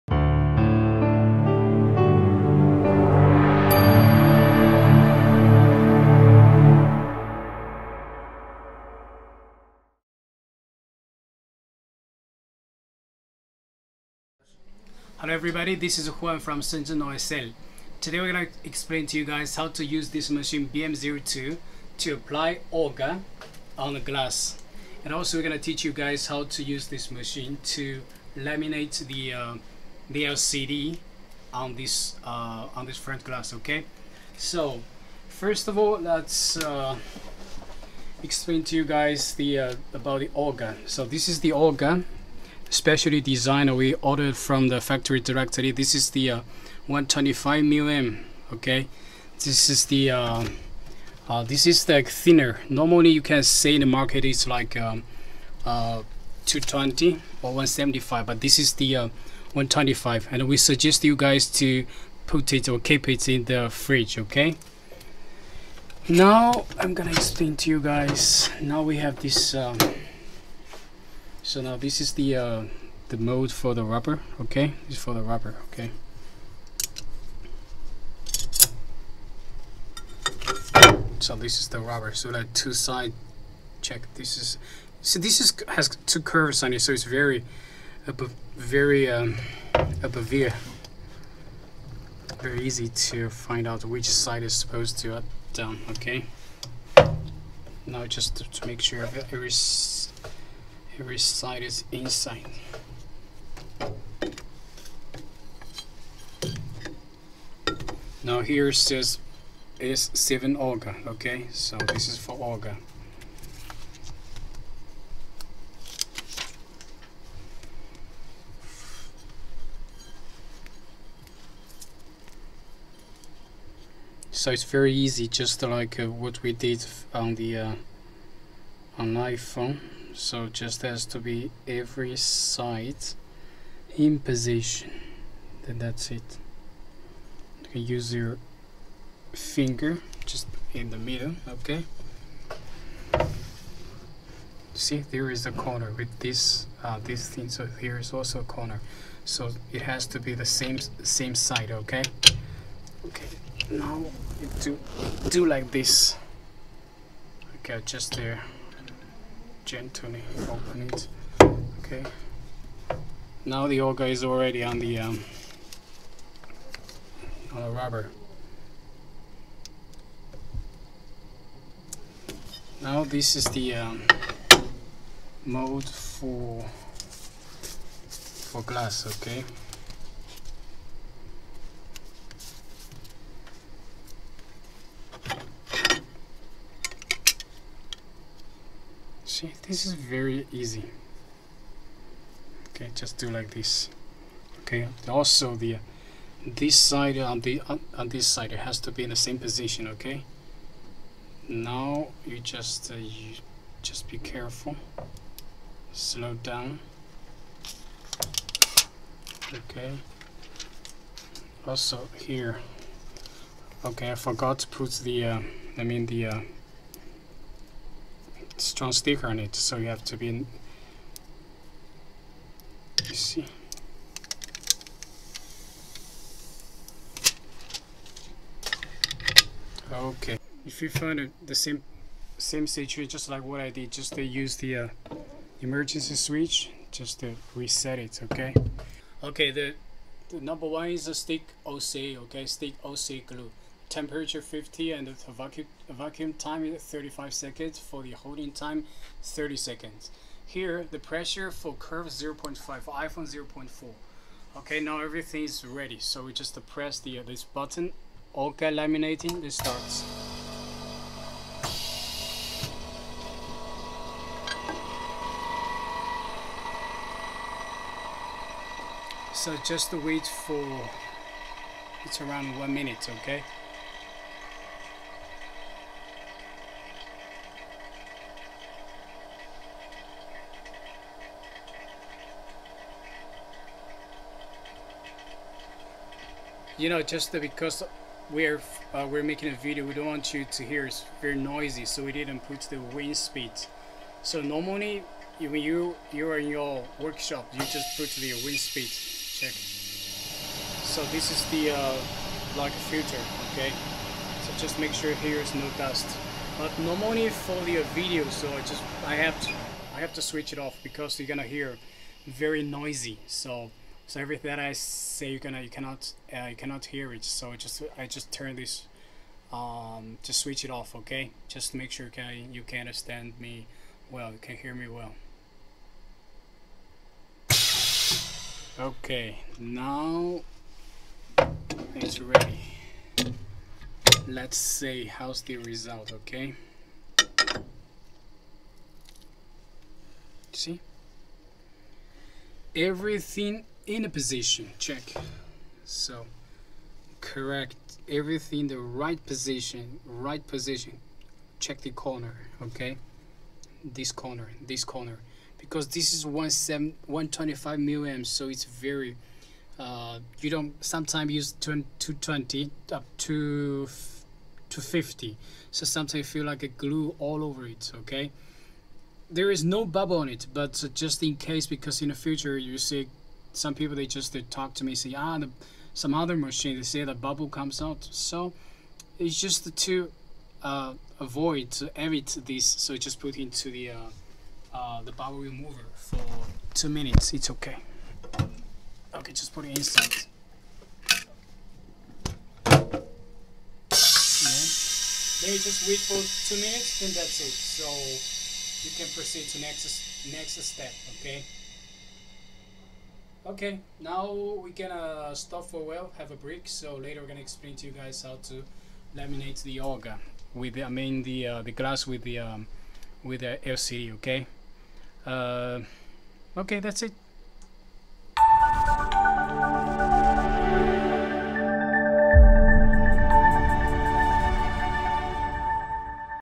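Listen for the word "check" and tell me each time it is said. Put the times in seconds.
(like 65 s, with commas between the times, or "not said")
83 s, 299 s, 344 s, 351 s.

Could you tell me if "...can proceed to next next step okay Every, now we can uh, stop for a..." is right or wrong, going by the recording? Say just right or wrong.
wrong.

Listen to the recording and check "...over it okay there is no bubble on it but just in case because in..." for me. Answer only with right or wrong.
right.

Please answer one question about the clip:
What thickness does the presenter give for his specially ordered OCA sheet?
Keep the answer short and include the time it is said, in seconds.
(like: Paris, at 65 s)
125 mm, at 46 s.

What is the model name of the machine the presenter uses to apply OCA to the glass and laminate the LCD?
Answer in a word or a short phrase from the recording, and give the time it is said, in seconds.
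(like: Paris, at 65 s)
BM02, at 20 s.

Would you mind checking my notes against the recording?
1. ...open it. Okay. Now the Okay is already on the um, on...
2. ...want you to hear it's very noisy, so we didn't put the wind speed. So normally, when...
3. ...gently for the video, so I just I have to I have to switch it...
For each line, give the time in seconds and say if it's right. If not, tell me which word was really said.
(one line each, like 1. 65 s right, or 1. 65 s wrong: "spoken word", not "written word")
1. 160 s wrong: "OCA", not "Okay"
2. 290 s right
3. 306 s wrong: "normally", not "gently".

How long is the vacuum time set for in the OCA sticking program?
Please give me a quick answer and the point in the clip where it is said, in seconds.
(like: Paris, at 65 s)
35 seconds, at 246 s.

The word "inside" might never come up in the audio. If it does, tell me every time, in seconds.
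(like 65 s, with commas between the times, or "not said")
101 s, 389 s.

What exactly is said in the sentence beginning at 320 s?
Okay, just make sure you can you can understand me well.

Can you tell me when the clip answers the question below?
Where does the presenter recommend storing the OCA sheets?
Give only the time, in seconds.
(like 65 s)
63 s.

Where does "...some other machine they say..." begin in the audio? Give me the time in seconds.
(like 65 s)
375 s.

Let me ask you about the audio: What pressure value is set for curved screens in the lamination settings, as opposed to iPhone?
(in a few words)
0.5.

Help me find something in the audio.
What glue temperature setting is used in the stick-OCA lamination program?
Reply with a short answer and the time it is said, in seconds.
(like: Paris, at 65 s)
50, at 243 s.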